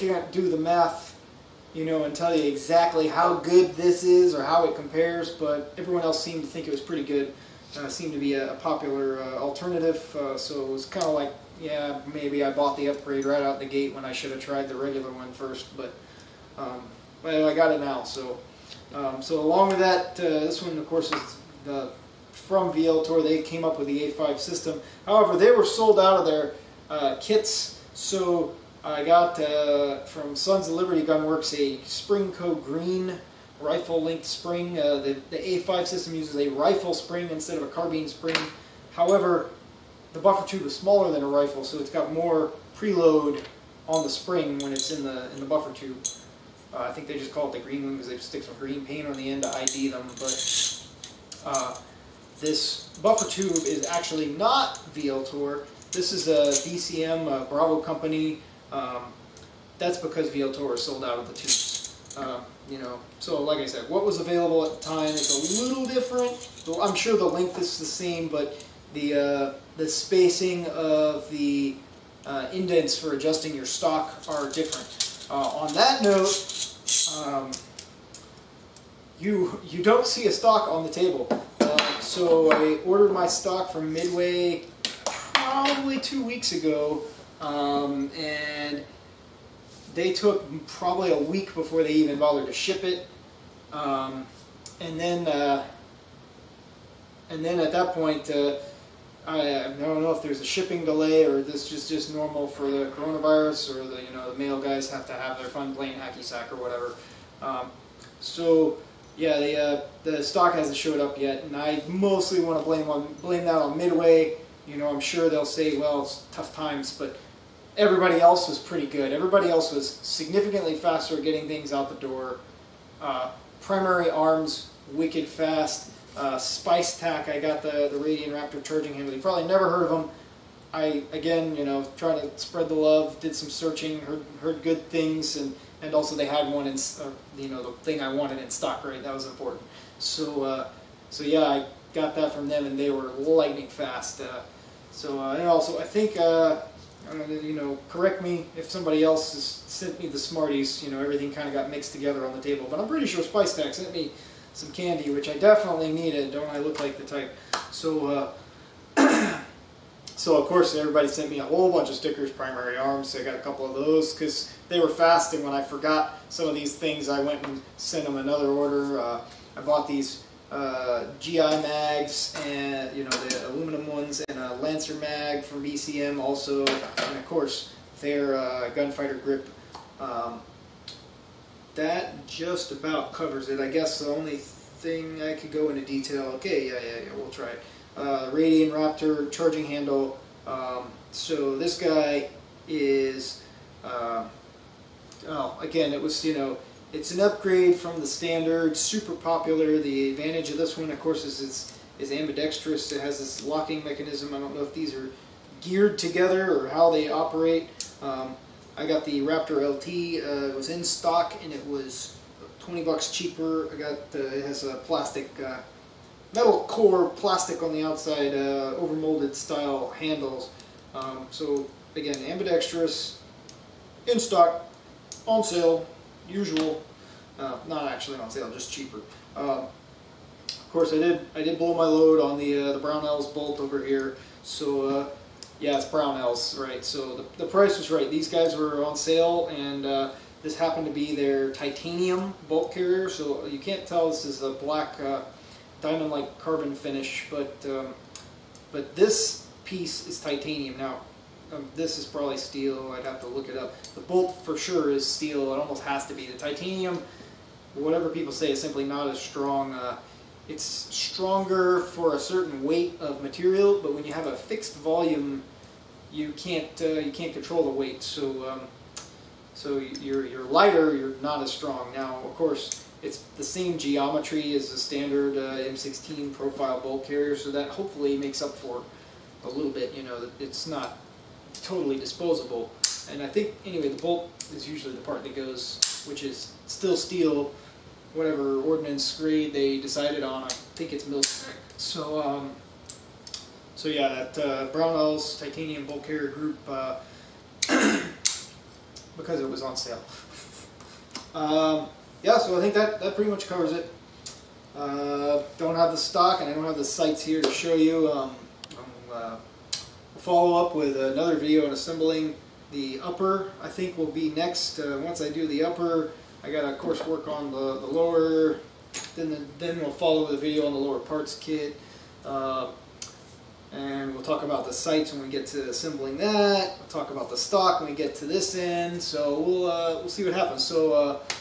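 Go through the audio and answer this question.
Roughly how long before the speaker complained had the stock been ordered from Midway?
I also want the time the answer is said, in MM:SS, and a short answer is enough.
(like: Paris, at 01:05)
2 weeks, at 01:25.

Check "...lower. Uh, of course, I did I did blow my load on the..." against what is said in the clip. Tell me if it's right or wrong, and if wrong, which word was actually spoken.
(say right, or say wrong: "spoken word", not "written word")
wrong: "cheaper", not "lower".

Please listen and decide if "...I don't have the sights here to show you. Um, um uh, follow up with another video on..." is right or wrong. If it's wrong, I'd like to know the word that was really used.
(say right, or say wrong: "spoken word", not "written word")
right.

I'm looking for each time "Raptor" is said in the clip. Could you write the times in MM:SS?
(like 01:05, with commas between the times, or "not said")
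02:08, 03:08, 03:29.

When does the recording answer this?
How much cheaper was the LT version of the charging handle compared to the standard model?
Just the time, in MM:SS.
03:32.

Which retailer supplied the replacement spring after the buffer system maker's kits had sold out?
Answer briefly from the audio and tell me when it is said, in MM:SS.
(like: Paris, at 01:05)
Sons of Liberty Gunworks, at 00:30.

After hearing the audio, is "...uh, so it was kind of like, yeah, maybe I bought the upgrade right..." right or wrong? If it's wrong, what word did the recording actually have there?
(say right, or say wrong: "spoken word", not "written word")
right.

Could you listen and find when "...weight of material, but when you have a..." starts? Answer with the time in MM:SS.
04:22.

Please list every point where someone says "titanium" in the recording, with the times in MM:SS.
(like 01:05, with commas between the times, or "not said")
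04:01, 04:10, 04:16, 04:55.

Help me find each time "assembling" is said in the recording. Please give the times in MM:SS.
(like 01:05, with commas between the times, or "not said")
05:11, 05:25.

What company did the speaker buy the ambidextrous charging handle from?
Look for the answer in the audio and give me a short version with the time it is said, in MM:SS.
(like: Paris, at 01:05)
Spice Tack, at 02:06.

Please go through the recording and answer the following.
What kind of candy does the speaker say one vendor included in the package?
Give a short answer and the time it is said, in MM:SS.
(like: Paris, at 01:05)
Smarties, at 02:30.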